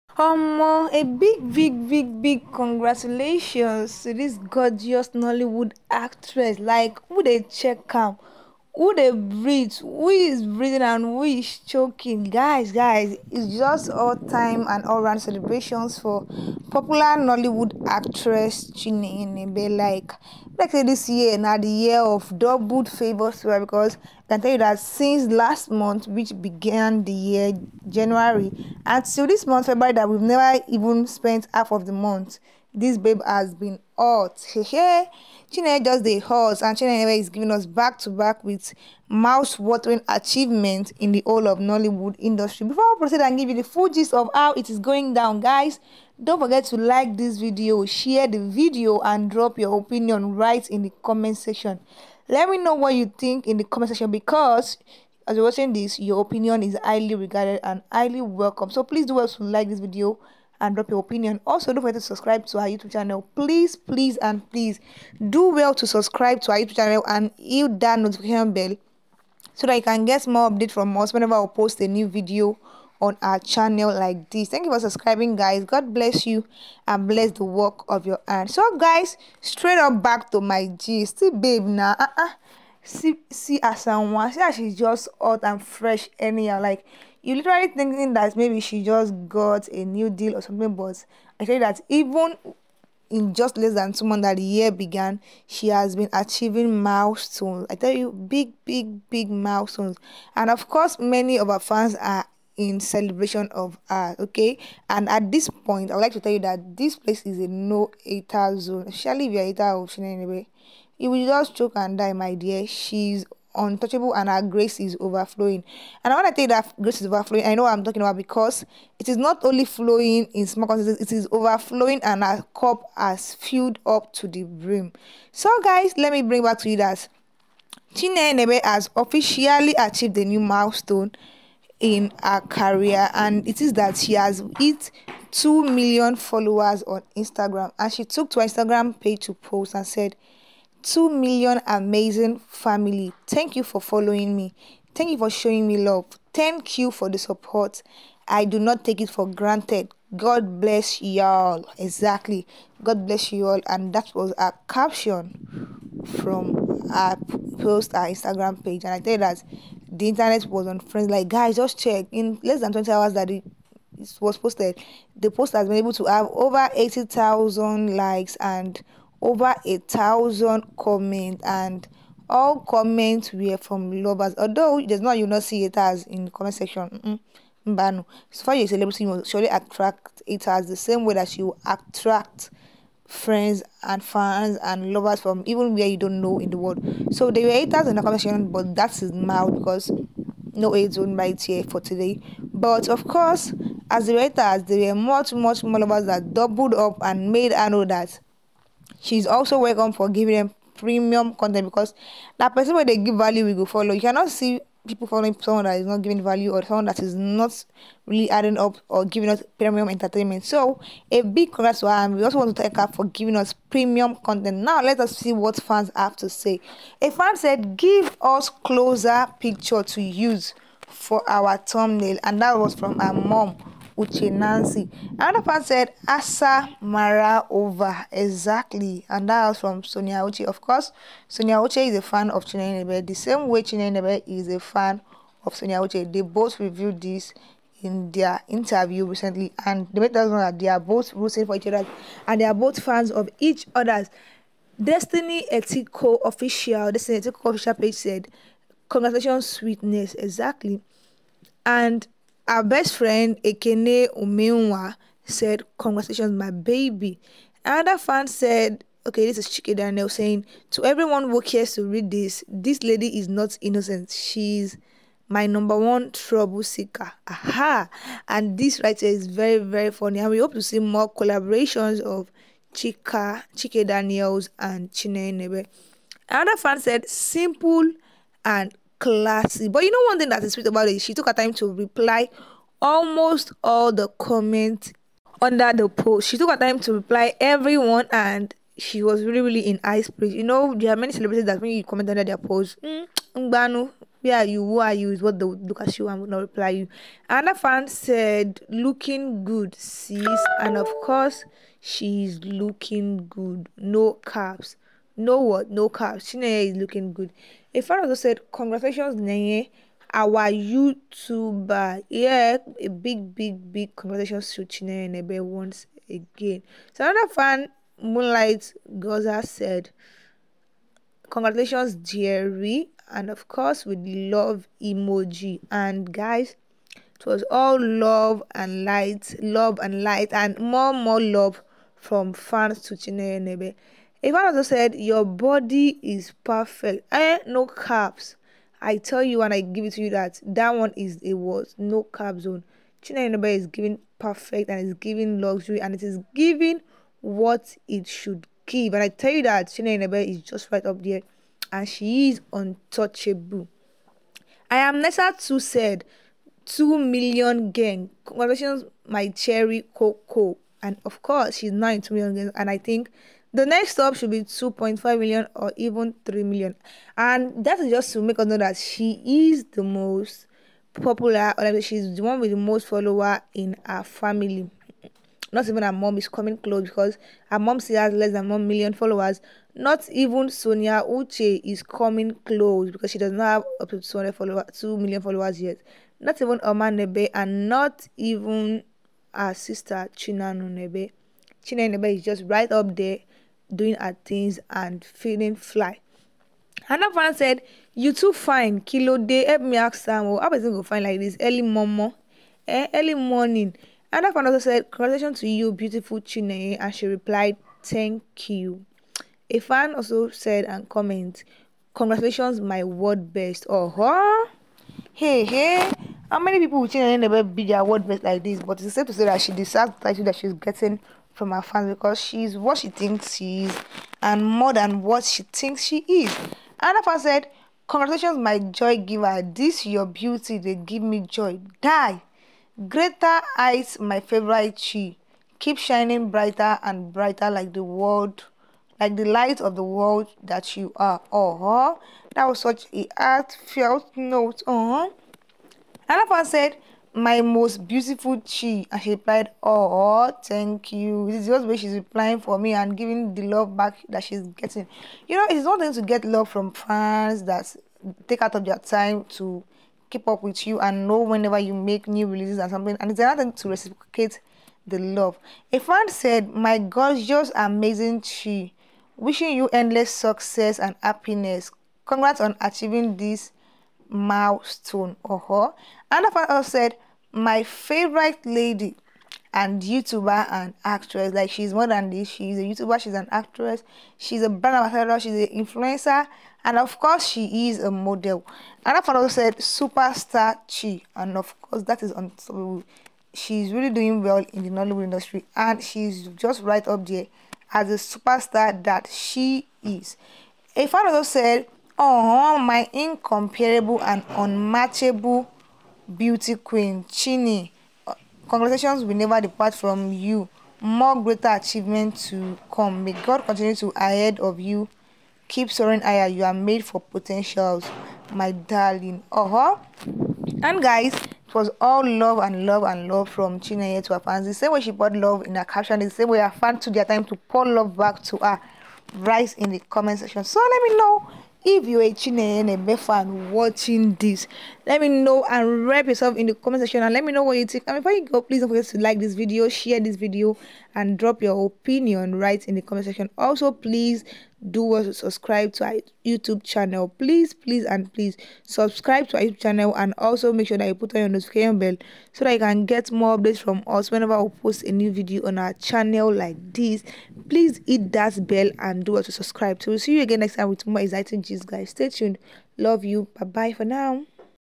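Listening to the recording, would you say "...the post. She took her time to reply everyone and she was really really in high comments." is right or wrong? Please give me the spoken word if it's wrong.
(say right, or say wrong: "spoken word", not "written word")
wrong: "spirits", not "comments".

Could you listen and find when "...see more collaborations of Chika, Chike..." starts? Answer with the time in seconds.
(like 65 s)
270 s.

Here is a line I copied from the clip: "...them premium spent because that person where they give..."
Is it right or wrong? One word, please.
wrong.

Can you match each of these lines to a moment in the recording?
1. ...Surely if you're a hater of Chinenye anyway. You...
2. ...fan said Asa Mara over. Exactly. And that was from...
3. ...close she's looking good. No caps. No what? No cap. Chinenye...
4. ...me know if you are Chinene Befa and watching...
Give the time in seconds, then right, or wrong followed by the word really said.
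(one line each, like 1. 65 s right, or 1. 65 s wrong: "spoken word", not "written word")
1. 108 s right
2. 225 s right
3. 301 s wrong: "course", not "close"
4. 530 s right.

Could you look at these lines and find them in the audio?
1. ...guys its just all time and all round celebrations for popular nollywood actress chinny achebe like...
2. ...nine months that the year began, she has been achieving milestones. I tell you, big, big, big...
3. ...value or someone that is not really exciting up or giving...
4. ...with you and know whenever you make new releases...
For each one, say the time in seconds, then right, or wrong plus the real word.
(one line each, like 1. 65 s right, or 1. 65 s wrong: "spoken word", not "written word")
1. 12 s right
2. 93 s wrong: "two", not "nine"
3. 206 s wrong: "adding", not "exciting"
4. 460 s right.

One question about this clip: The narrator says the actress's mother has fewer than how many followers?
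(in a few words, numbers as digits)
1 million.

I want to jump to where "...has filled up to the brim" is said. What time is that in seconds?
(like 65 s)
122 s.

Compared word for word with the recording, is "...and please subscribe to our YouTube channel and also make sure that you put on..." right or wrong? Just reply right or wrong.
right.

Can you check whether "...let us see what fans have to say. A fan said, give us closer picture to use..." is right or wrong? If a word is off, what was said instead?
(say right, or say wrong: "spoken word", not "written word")
right.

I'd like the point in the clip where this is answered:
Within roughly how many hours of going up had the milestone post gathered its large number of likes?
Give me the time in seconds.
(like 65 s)
162 s.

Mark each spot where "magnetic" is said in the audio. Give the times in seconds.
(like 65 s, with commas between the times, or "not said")
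not said.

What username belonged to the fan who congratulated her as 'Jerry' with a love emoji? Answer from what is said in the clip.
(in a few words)
Moonlight Goza.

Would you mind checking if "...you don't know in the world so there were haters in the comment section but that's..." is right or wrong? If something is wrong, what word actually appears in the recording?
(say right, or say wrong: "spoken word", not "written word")
right.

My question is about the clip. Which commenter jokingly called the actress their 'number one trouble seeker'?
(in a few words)
Chika Daniel.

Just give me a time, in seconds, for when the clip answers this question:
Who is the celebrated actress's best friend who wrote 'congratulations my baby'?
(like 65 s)
253 s.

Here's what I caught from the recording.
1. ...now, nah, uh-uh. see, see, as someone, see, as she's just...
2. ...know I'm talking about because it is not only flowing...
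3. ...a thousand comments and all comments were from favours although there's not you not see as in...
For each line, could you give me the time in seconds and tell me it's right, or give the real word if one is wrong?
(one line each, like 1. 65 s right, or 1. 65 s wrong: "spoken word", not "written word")
1. 81 s right
2. 117 s right
3. 169 s wrong: "lovers", not "favours".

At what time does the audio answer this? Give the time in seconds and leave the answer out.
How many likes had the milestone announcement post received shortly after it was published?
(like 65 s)
166 s.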